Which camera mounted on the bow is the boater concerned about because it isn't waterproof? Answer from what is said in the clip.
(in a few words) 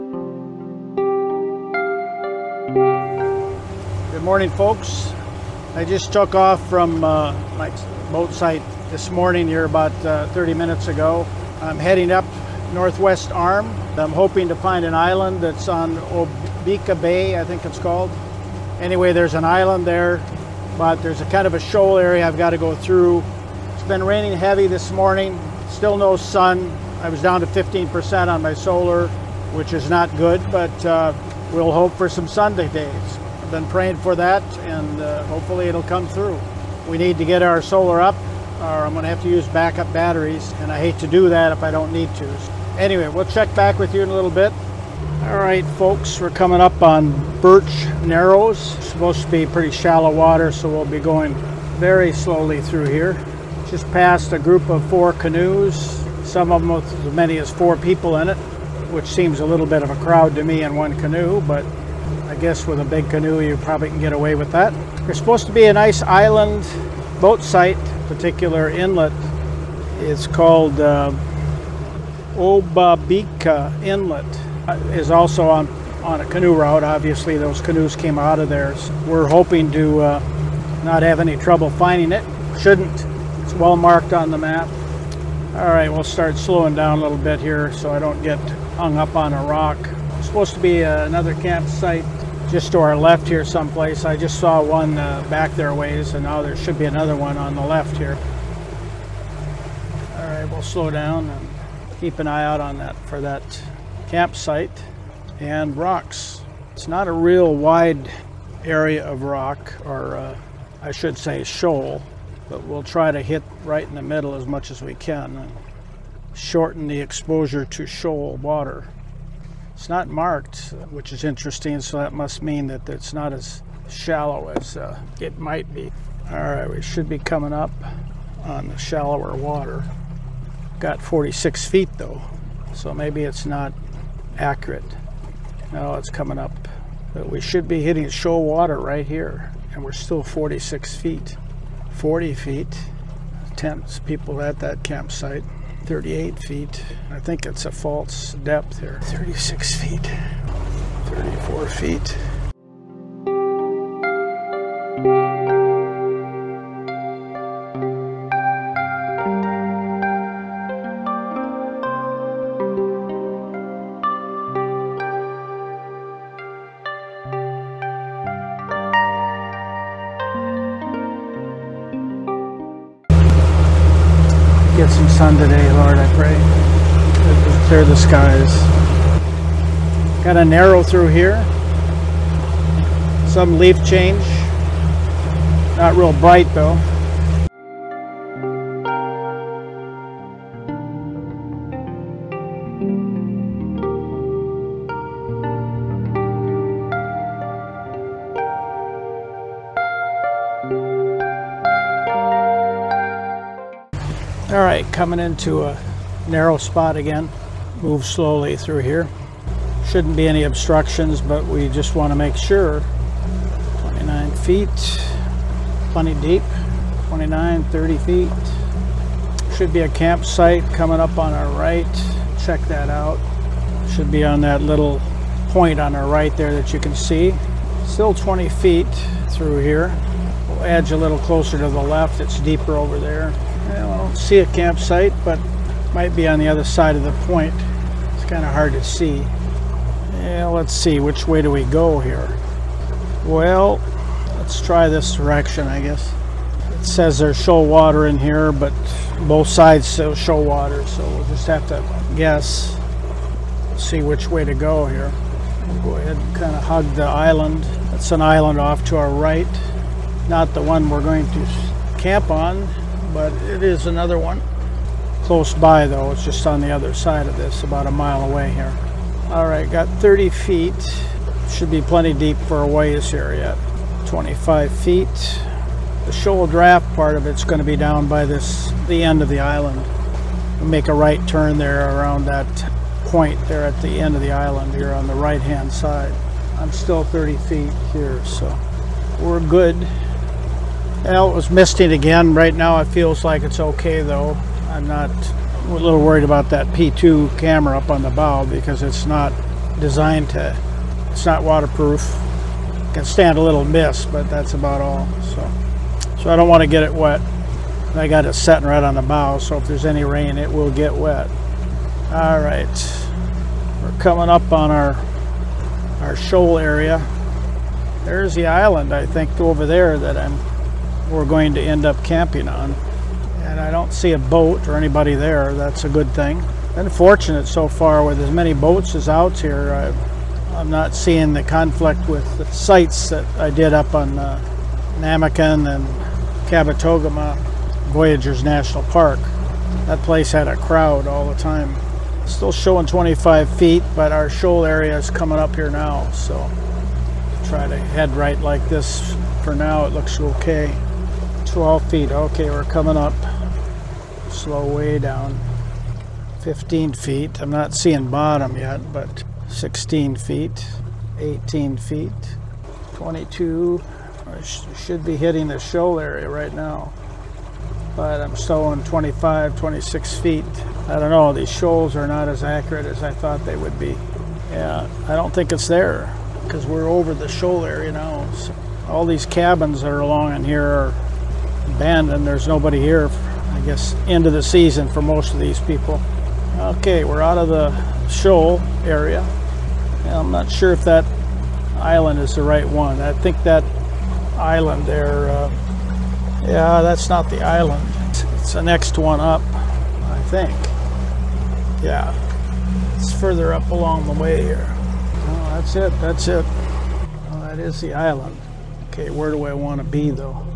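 P2.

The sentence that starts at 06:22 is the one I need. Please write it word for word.
There's nobody here, I guess, end of the season for most of these people.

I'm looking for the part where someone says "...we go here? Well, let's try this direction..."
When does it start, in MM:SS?
04:01.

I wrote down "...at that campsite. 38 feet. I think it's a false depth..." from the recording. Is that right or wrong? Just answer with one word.
right.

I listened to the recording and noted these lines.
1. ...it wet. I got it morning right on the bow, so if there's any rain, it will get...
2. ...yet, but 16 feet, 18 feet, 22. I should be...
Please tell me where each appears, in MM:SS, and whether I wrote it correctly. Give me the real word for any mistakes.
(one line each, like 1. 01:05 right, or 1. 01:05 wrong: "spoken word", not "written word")
1. 05:06 wrong: "setting", not "morning"
2. 05:58 right.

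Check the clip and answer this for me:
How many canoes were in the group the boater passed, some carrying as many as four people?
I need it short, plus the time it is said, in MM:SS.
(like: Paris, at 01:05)
4, at 00:54.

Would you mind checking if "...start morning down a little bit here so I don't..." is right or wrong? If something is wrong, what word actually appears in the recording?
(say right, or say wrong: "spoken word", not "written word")
wrong: "slowing", not "morning".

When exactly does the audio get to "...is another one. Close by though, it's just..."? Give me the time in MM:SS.
04:23.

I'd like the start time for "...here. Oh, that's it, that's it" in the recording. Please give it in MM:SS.
06:44.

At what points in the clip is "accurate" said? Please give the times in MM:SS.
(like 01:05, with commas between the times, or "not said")
02:14, 06:12.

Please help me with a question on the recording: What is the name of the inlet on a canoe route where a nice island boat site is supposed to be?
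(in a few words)
Obabika Inlet.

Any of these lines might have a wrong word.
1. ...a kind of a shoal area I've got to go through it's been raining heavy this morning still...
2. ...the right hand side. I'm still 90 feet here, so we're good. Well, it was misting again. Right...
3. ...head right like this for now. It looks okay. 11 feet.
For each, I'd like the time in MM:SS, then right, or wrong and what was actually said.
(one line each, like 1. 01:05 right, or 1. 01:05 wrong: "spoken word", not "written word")
1. 00:21 right
2. 04:45 wrong: "30", not "90"
3. 05:47 wrong: "12", not "11".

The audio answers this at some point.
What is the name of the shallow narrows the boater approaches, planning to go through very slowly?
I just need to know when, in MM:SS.
00:47.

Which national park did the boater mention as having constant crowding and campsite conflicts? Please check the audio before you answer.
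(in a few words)
Voyageurs National Park.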